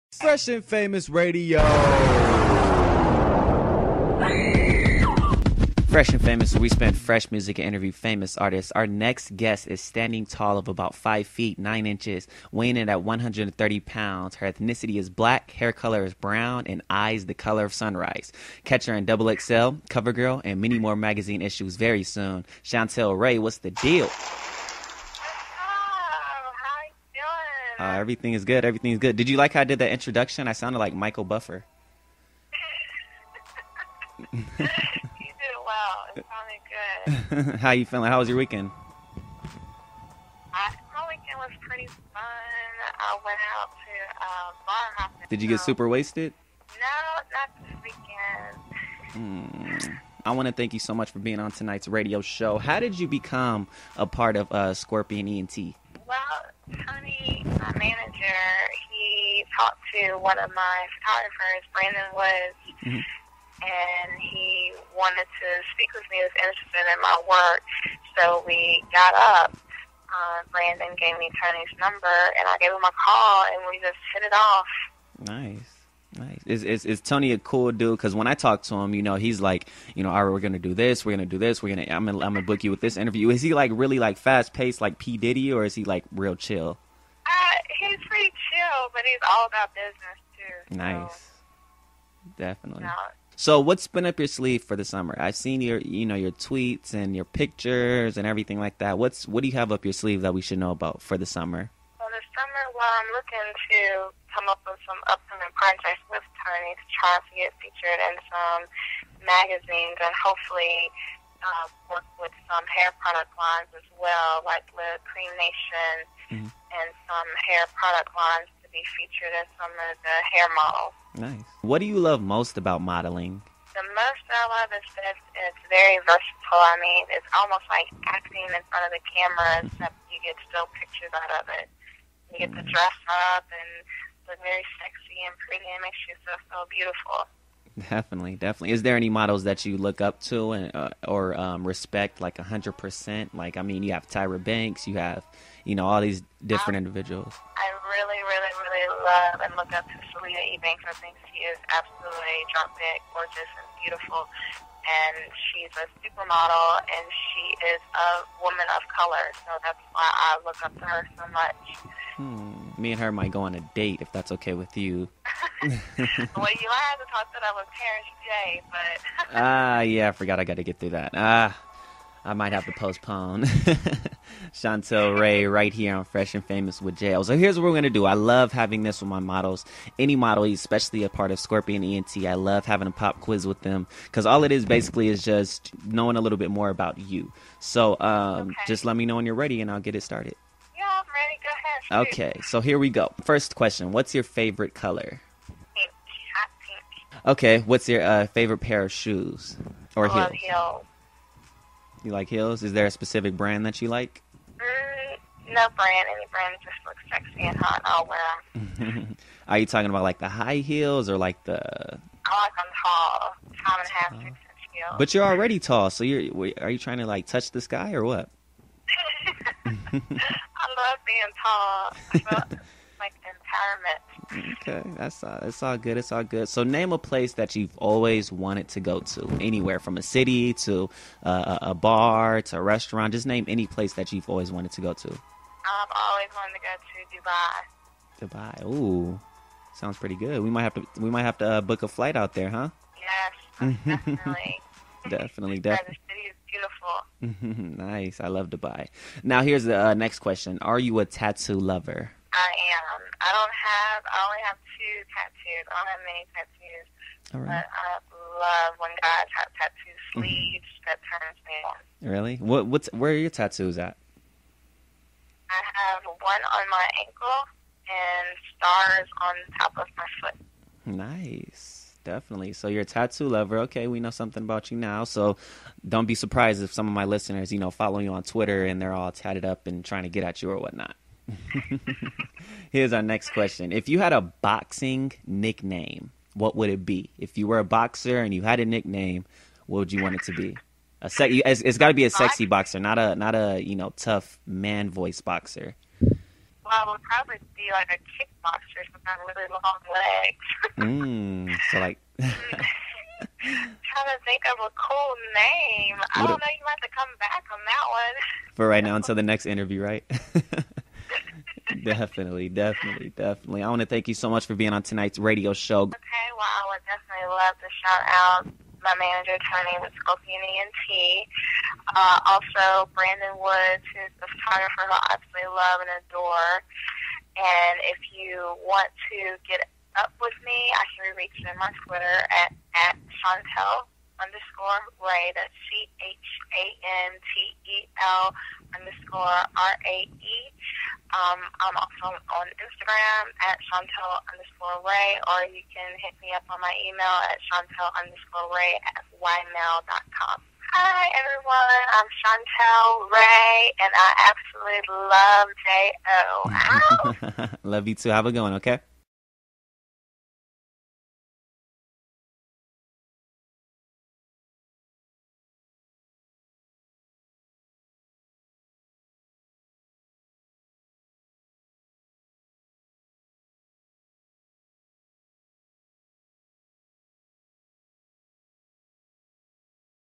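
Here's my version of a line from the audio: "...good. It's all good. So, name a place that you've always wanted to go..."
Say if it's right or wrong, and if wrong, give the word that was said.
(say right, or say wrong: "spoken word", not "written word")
right.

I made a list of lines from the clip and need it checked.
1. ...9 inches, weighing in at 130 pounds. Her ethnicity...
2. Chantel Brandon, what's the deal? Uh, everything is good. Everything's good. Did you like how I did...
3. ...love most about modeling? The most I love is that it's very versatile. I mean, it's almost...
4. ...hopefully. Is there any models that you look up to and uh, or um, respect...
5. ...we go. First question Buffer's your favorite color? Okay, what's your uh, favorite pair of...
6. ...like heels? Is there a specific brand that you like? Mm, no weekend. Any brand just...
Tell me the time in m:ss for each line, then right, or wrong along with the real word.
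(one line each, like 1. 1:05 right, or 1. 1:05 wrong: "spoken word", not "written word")
1. 0:11 right
2. 0:22 wrong: "Rae", not "Brandon"
3. 2:01 right
4. 2:18 wrong: "definitely", not "hopefully"
5. 3:12 wrong: "What", not "Buffer"
6. 3:22 wrong: "brand", not "weekend".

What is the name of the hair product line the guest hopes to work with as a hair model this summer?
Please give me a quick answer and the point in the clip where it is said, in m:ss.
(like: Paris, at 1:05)
Cream Nation, at 1:55.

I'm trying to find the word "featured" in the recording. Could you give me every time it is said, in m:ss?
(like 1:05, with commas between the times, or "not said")
1:47, 1:58.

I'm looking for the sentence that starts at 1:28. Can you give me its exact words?
but he's all about business too.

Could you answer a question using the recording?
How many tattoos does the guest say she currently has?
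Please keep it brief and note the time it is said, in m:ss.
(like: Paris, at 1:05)
2, at 4:14.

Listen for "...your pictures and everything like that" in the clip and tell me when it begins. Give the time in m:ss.
1:37.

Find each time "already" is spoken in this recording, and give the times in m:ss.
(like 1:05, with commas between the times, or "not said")
3:35.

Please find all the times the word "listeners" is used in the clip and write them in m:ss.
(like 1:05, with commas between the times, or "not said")
4:37.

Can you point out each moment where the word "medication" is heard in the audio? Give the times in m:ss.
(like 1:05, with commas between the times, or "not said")
not said.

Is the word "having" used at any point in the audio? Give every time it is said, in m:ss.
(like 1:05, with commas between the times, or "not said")
2:58, 3:02.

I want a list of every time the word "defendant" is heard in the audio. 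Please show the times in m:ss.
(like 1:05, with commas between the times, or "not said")
not said.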